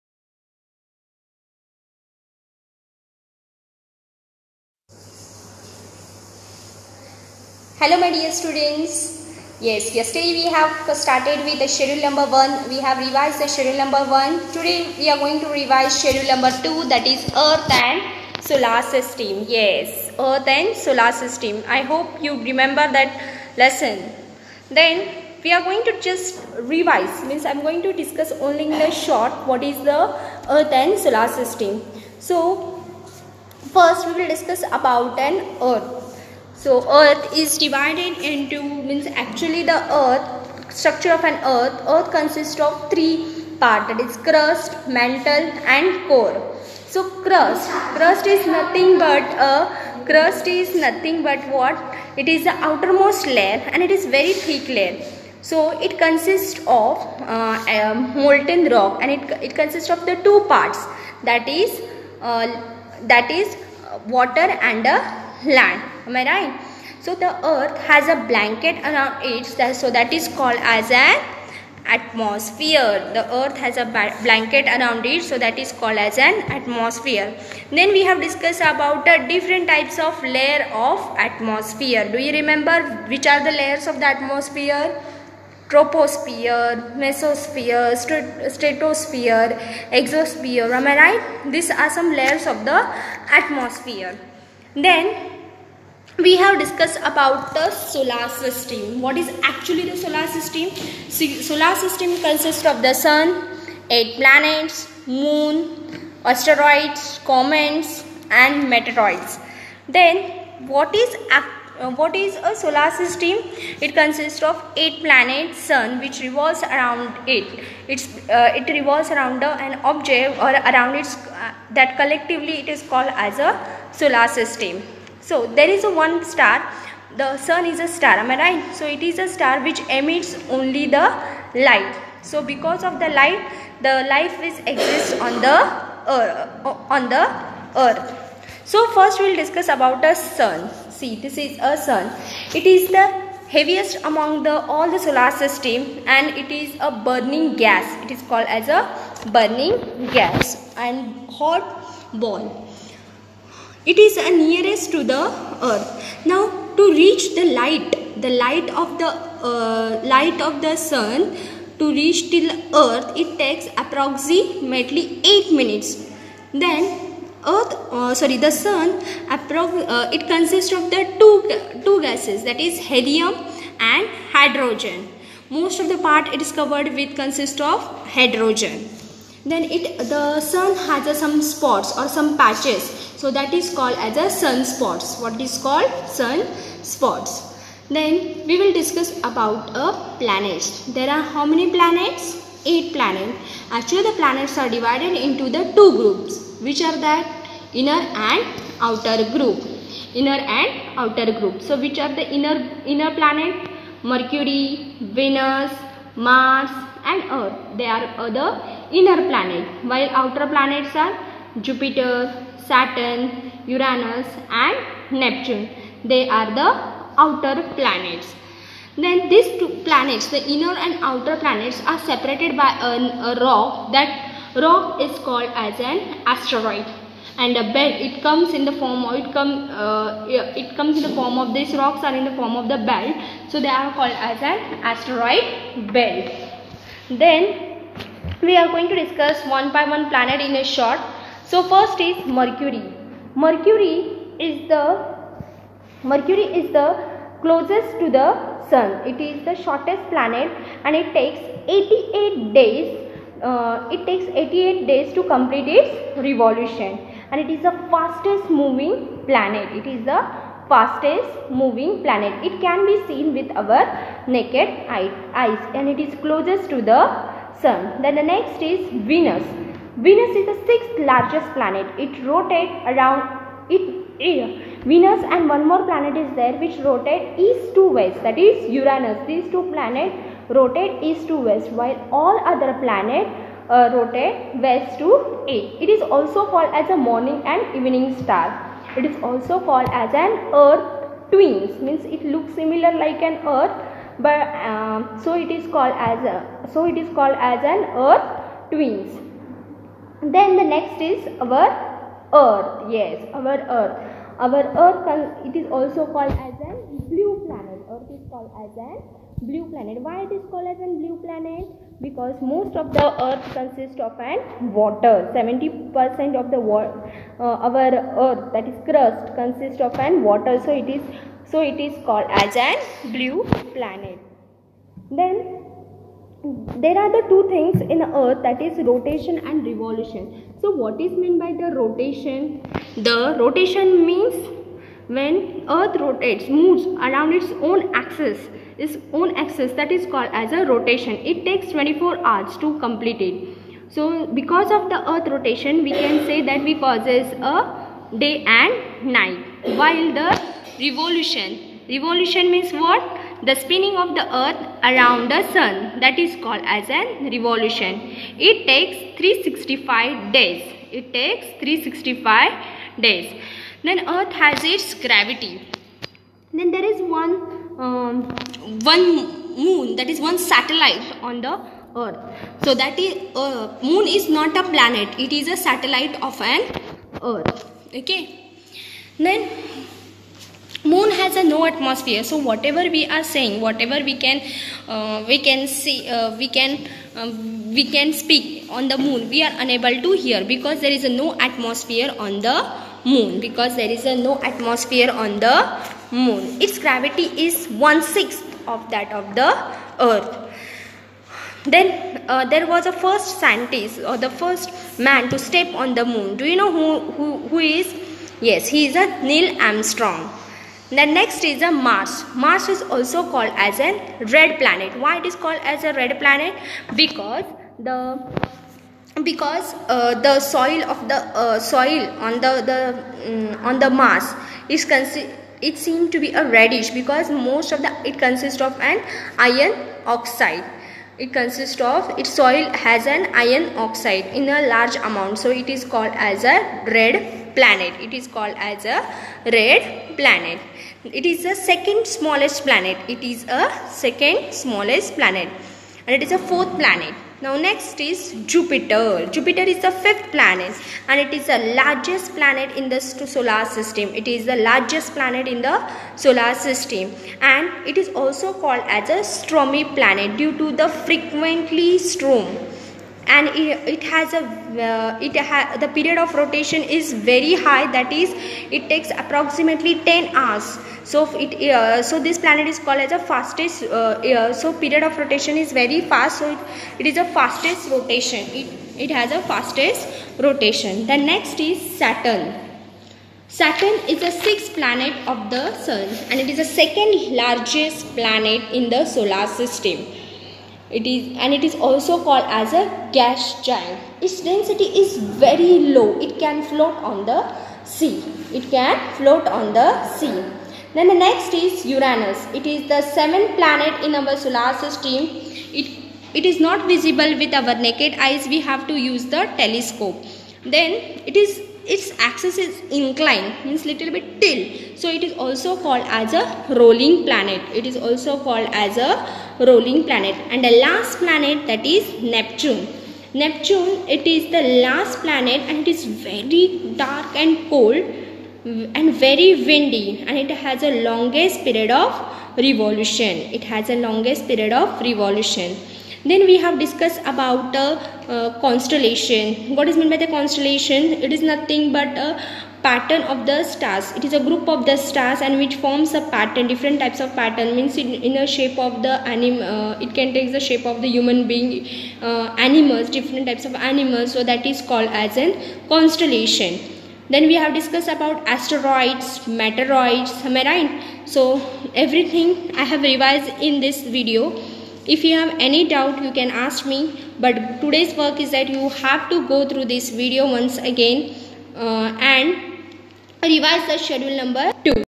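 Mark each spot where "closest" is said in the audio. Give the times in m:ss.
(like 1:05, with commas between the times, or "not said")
4:07, 4:26.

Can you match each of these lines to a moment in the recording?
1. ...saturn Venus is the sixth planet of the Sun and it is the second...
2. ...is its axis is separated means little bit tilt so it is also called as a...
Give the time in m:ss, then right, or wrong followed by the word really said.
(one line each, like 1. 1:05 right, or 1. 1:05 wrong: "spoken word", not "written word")
1. 8:01 wrong: "Saturn", not "Venus"
2. 8:31 wrong: "inclined", not "separated".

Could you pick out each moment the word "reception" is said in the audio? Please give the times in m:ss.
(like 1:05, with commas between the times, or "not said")
not said.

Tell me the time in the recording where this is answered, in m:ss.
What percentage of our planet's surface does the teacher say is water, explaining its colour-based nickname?
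5:15.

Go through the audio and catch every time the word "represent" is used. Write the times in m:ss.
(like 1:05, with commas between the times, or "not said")
not said.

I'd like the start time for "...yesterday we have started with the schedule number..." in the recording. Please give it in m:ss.
0:09.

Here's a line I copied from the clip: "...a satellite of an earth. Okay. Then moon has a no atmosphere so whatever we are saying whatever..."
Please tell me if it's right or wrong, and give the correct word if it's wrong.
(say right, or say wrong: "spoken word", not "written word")
right.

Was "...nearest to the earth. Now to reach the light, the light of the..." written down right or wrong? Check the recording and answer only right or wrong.
right.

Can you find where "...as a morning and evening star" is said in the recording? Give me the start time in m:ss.
4:46.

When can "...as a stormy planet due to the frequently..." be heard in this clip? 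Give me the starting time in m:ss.
7:38.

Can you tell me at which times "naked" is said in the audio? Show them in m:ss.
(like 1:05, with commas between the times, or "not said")
4:24, 8:27.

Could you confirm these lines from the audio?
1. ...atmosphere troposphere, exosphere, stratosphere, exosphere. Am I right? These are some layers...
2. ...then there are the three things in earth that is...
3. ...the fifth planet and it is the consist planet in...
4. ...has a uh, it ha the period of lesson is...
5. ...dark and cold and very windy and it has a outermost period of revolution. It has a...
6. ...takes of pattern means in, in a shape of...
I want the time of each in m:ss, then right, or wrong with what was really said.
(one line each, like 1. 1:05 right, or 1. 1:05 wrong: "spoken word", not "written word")
1. 1:24 wrong: "mesosphere", not "exosphere"
2. 5:25 wrong: "two", not "three"
3. 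7:29 wrong: "largest", not "consist"
4. 7:44 wrong: "rotation", not "lesson"
5. 8:47 wrong: "longest", not "outermost"
6. 9:06 wrong: "types", not "takes".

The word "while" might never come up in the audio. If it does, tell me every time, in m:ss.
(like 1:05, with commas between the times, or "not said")
3:29, 4:41, 5:49.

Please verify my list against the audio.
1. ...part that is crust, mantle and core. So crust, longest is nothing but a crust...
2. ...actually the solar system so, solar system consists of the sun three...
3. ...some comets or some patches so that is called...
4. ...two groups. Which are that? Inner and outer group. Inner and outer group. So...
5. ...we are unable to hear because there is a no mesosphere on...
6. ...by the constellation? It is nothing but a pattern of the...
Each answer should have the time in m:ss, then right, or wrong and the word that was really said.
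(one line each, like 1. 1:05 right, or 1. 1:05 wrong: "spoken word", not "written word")
1. 0:43 wrong: "crust", not "longest"
2. 1:39 wrong: "eight", not "three"
3. 3:01 wrong: "spots", not "comets"
4. 3:15 right
5. 6:29 wrong: "atmosphere", not "mesosphere"
6. 9:00 right.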